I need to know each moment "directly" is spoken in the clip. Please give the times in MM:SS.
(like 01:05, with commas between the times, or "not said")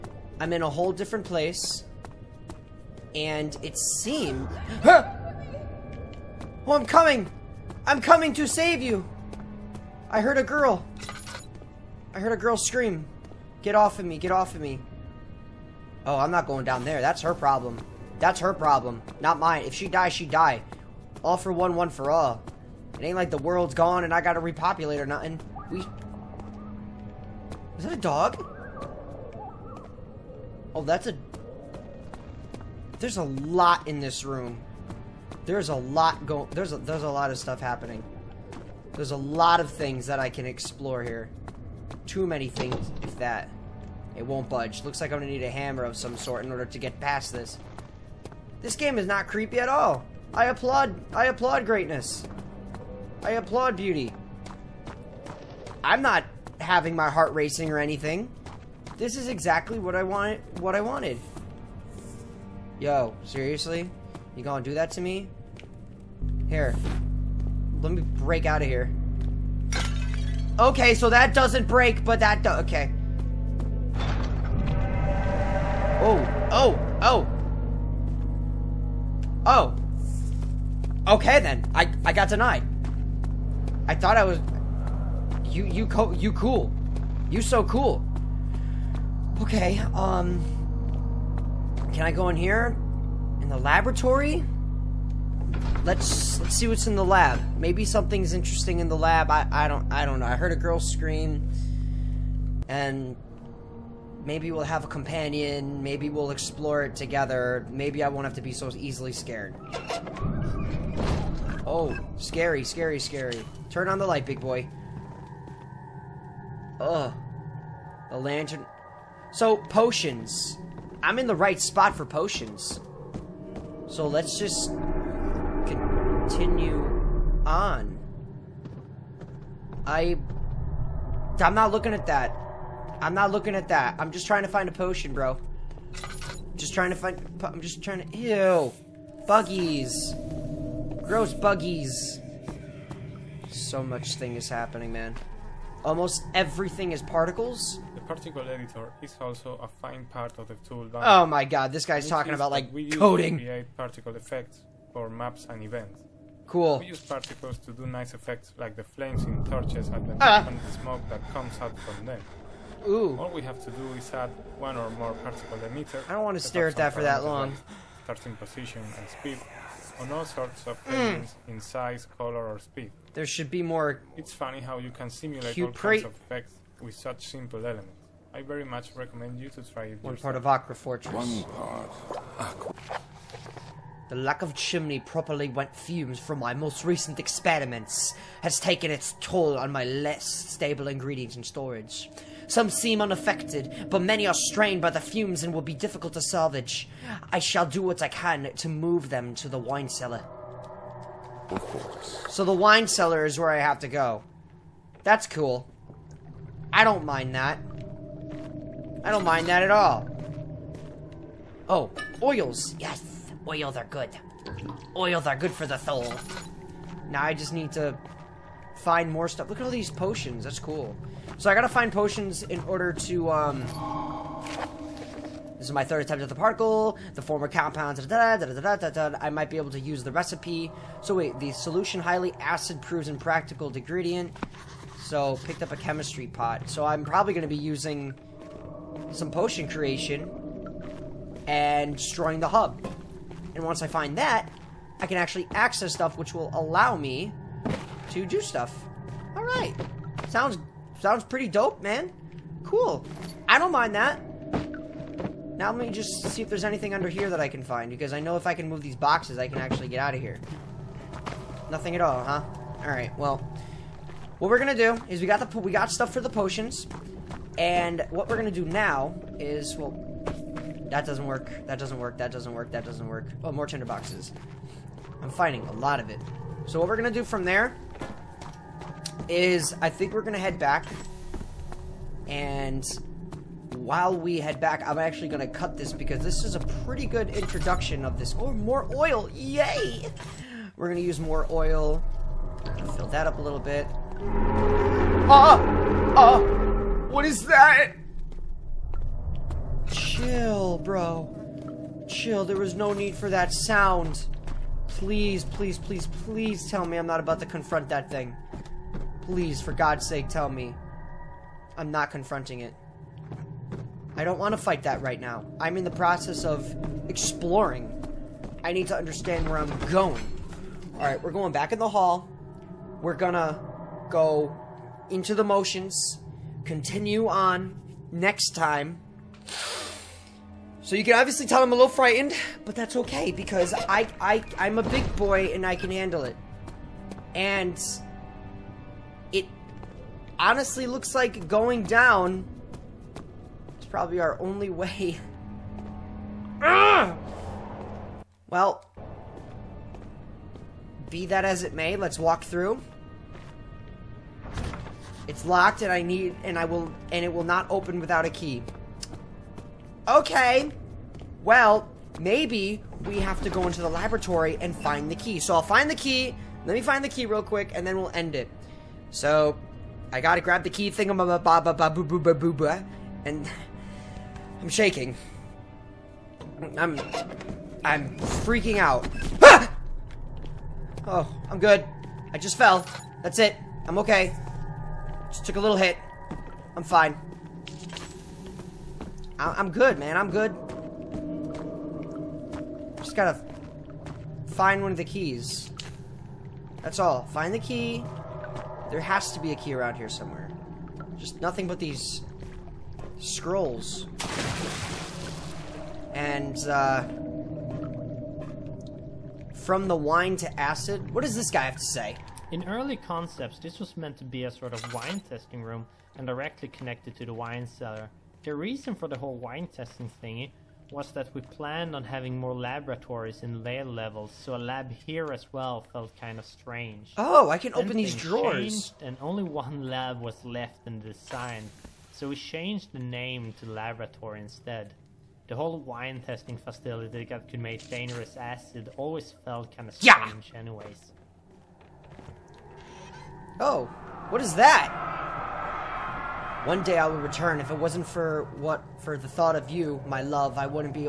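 06:56.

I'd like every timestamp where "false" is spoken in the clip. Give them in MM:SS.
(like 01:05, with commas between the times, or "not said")
not said.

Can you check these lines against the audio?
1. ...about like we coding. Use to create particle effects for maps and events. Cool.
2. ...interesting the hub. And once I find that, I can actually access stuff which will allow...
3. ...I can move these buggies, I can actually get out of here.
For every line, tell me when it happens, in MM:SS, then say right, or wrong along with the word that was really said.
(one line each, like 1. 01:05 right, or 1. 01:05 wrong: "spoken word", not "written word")
1. 02:32 right
2. 04:01 wrong: "destroying", not "interesting"
3. 04:18 wrong: "boxes", not "buggies".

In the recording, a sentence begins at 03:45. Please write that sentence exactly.
This is my third attempt at the particle.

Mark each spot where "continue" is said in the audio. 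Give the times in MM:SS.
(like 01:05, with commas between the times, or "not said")
02:06, 05:26.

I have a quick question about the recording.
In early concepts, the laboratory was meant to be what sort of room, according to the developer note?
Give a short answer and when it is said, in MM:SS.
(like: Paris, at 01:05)
Wine testing room, at 06:54.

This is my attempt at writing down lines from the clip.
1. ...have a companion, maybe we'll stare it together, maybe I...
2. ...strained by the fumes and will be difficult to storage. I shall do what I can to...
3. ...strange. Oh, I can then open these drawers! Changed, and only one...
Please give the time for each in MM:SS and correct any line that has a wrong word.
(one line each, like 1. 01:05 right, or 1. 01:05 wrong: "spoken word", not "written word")
1. 01:44 wrong: "explore", not "stare"
2. 03:14 wrong: "salvage", not "storage"
3. 07:06 right.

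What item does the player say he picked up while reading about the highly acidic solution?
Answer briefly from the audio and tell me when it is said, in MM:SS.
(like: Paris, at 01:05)
Chemistry pot, at 03:55.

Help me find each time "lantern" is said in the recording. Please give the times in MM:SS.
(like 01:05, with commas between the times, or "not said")
01:58.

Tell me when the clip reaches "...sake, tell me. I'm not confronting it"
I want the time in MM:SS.
05:10.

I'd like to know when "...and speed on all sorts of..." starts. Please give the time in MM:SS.
02:48.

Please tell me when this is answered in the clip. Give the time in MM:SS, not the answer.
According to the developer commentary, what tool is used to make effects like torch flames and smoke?
02:28.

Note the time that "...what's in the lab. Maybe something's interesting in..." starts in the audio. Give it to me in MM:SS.
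01:36.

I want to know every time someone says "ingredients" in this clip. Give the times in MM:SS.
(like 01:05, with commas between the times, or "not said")
03:10, 03:53.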